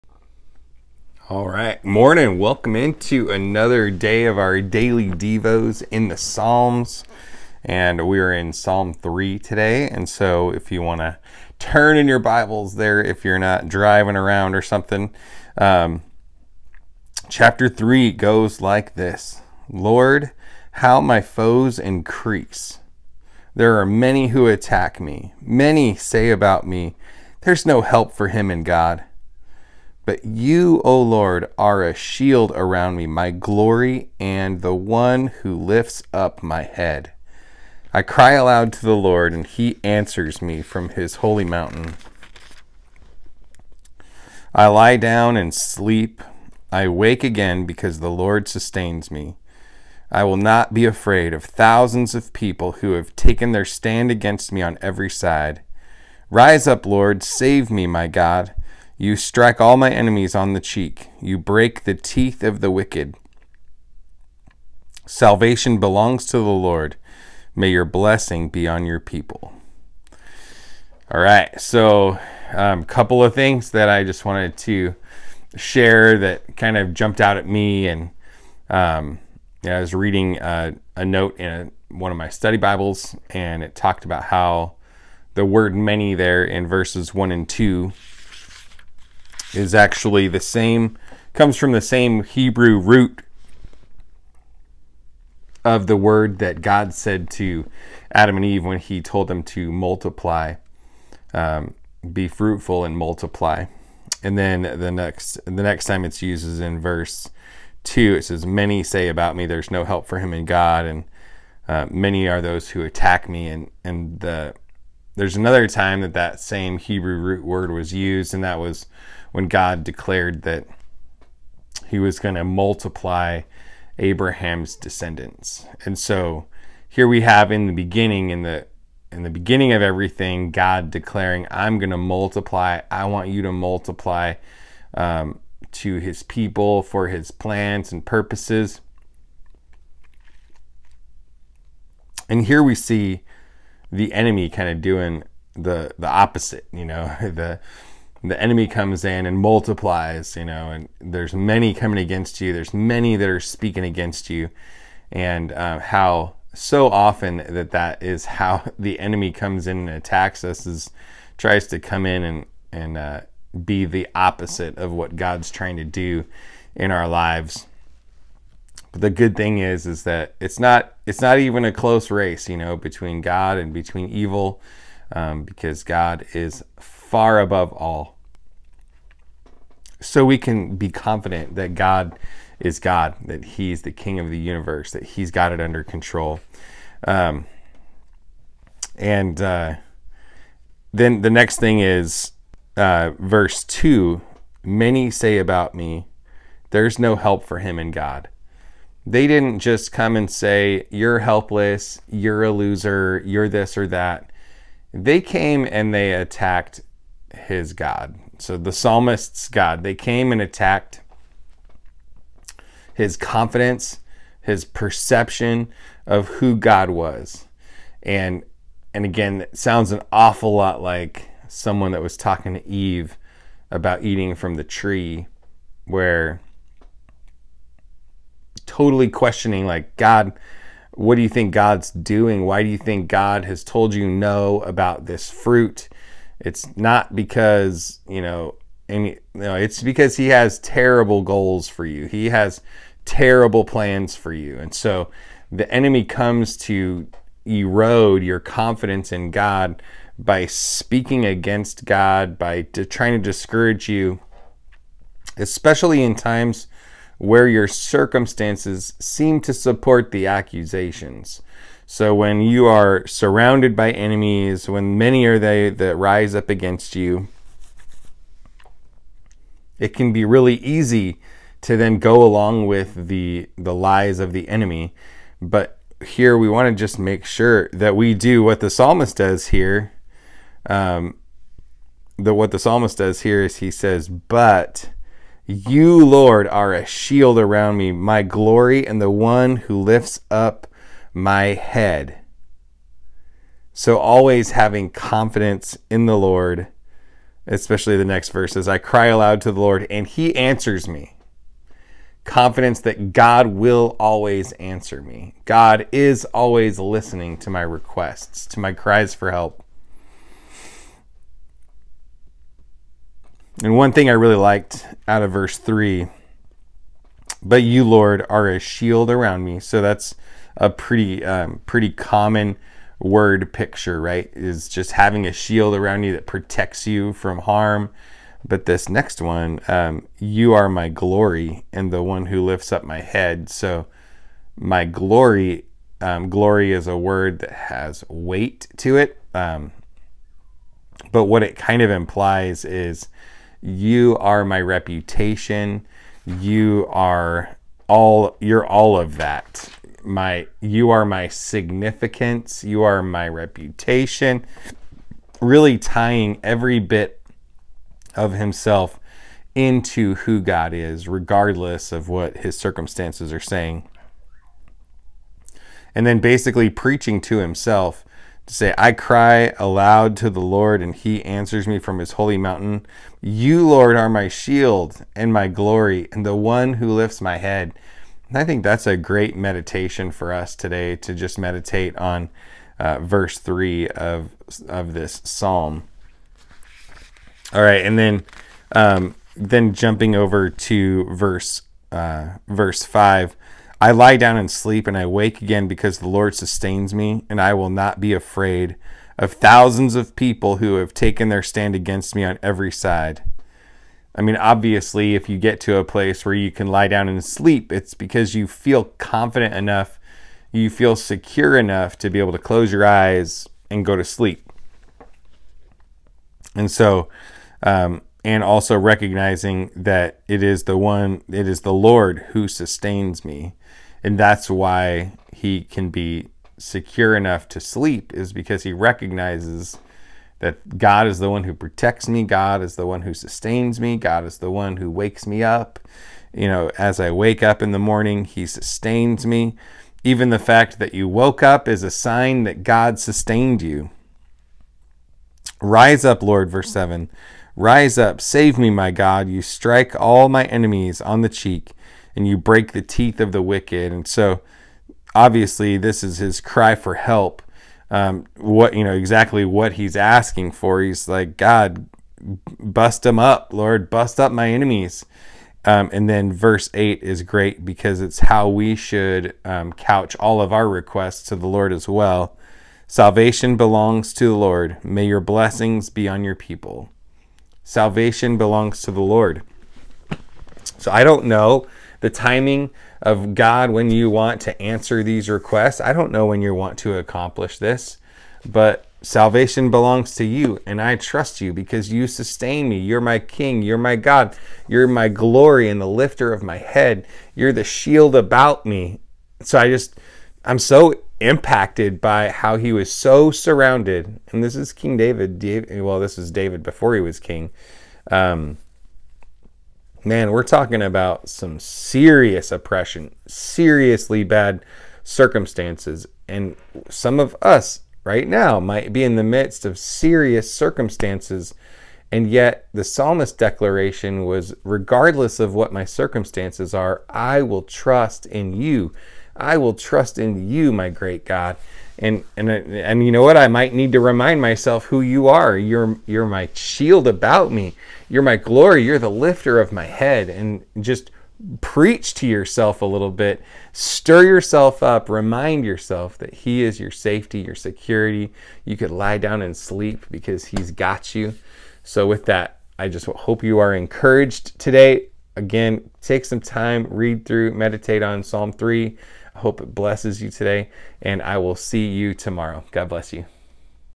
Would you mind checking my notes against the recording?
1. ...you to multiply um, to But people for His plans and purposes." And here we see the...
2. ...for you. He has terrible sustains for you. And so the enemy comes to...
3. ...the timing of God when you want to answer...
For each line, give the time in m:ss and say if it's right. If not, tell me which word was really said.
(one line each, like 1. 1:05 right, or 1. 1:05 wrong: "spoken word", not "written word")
1. 2:13 wrong: "His", not "But"
2. 4:01 wrong: "plans", not "sustains"
3. 8:01 right.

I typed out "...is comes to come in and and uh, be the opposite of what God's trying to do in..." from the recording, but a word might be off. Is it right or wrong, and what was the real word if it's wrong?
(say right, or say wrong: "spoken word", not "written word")
wrong: "tries", not "comes".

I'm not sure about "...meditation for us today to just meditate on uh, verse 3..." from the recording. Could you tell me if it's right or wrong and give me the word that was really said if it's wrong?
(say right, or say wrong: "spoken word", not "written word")
right.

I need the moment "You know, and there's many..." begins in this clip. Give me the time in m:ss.
2:30.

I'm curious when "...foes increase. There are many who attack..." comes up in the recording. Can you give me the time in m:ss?
0:21.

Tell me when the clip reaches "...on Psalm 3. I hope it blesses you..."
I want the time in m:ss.
9:18.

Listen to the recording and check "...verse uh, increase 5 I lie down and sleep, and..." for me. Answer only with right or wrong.
wrong.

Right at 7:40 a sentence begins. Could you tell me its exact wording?
He's like, God, bust them up, Lord, bust up my enemies.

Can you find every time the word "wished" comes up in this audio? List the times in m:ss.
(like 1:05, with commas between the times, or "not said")
not said.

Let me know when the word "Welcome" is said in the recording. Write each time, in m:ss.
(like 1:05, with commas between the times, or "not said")
0:02.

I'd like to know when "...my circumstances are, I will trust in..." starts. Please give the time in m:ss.
8:45.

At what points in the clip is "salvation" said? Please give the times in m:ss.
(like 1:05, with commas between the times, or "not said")
1:05, 7:52, 7:57, 8:09.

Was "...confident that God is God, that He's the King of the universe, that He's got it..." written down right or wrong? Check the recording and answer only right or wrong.
right.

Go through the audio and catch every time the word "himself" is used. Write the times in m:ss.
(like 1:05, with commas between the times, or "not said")
5:58, 6:07.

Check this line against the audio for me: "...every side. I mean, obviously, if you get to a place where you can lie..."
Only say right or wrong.
right.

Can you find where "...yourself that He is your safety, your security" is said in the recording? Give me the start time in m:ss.
9:05.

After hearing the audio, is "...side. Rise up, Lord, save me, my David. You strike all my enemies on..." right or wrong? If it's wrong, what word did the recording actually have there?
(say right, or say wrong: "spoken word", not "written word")
wrong: "God", not "David".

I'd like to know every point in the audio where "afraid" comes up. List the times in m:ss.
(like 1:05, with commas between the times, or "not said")
0:50, 6:38.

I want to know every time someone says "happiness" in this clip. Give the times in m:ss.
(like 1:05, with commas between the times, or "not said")
not said.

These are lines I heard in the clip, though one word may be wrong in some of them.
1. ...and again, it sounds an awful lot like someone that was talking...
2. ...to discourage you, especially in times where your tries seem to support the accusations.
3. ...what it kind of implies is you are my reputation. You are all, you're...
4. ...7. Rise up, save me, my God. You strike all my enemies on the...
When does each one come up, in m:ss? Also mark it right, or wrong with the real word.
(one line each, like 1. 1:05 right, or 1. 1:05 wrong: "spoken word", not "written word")
1. 3:38 right
2. 4:13 wrong: "circumstances", not "tries"
3. 5:41 right
4. 7:26 right.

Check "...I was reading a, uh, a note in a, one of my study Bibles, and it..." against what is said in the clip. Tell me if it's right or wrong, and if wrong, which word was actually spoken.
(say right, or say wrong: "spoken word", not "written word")
right.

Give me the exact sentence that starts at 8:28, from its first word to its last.
Um, man, we're talking about some serious oppression, seriously bad circumstances.